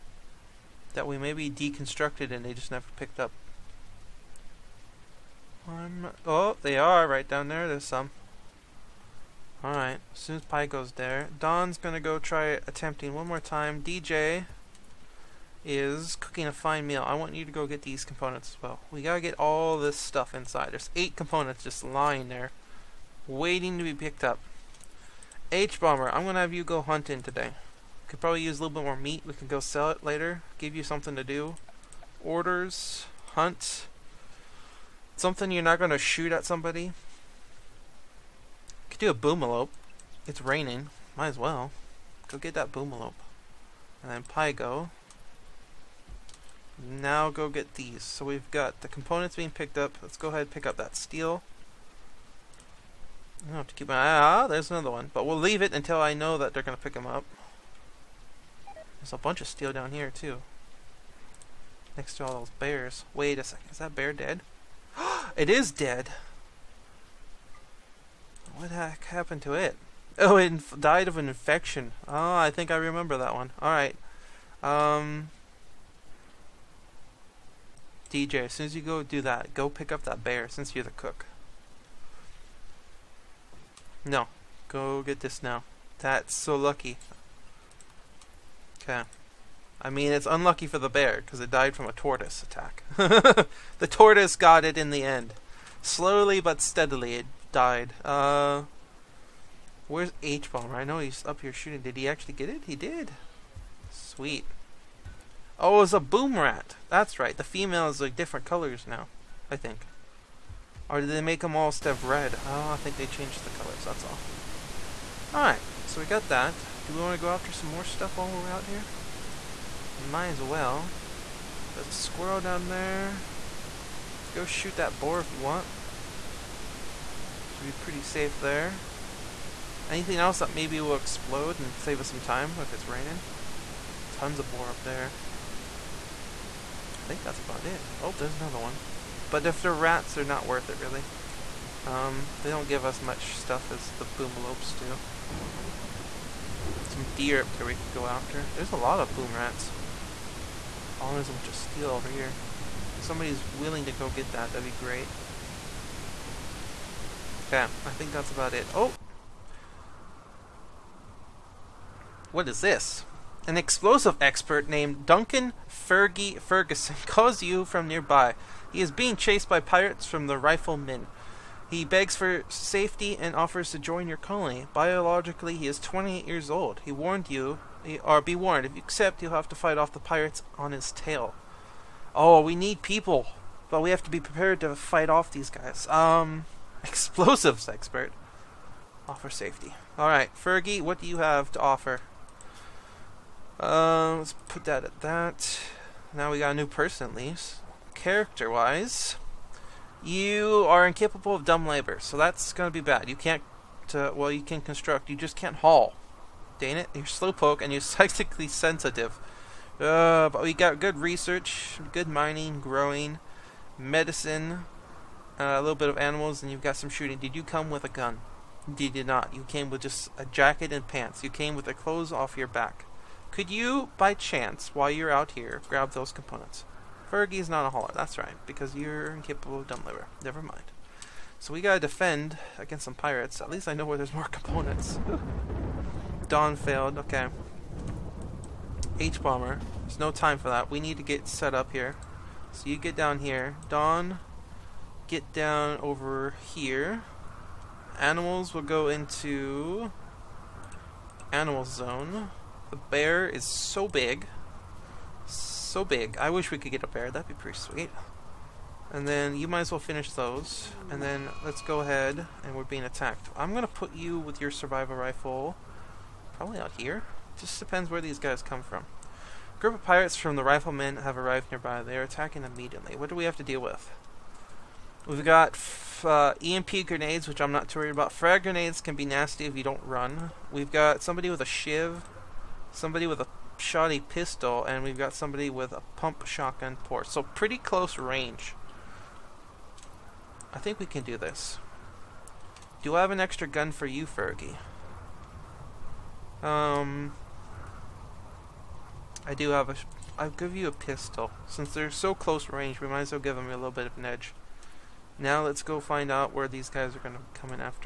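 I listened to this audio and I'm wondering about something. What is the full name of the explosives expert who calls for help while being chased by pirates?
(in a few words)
Duncan Fergie Ferguson.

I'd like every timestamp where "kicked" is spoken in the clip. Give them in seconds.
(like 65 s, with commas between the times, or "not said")
not said.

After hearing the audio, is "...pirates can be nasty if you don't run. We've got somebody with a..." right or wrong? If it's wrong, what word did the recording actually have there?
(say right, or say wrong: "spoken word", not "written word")
wrong: "grenades", not "pirates".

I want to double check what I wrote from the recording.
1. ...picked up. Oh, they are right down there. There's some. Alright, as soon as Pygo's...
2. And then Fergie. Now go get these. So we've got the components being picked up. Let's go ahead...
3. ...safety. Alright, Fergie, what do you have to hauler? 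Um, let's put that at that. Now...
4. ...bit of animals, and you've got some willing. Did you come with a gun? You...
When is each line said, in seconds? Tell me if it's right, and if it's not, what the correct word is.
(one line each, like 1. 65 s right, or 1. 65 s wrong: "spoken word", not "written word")
1. 2 s right
2. 44 s wrong: "Pygo", not "Fergie"
3. 189 s wrong: "offer", not "hauler"
4. 215 s wrong: "shooting", not "willing".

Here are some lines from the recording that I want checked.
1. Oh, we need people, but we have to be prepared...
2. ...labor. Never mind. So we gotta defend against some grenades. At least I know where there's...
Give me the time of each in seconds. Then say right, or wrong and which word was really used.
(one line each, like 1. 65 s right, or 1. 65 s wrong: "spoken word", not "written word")
1. 182 s right
2. 229 s wrong: "pirates", not "grenades".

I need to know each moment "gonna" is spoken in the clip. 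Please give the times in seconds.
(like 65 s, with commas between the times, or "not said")
11 s, 26 s.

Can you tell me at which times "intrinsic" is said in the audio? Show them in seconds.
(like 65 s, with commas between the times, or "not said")
not said.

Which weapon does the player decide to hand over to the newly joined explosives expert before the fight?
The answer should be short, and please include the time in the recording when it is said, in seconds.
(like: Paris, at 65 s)
A pistol, at 300 s.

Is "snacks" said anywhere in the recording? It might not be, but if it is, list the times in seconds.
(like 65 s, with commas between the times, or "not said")
not said.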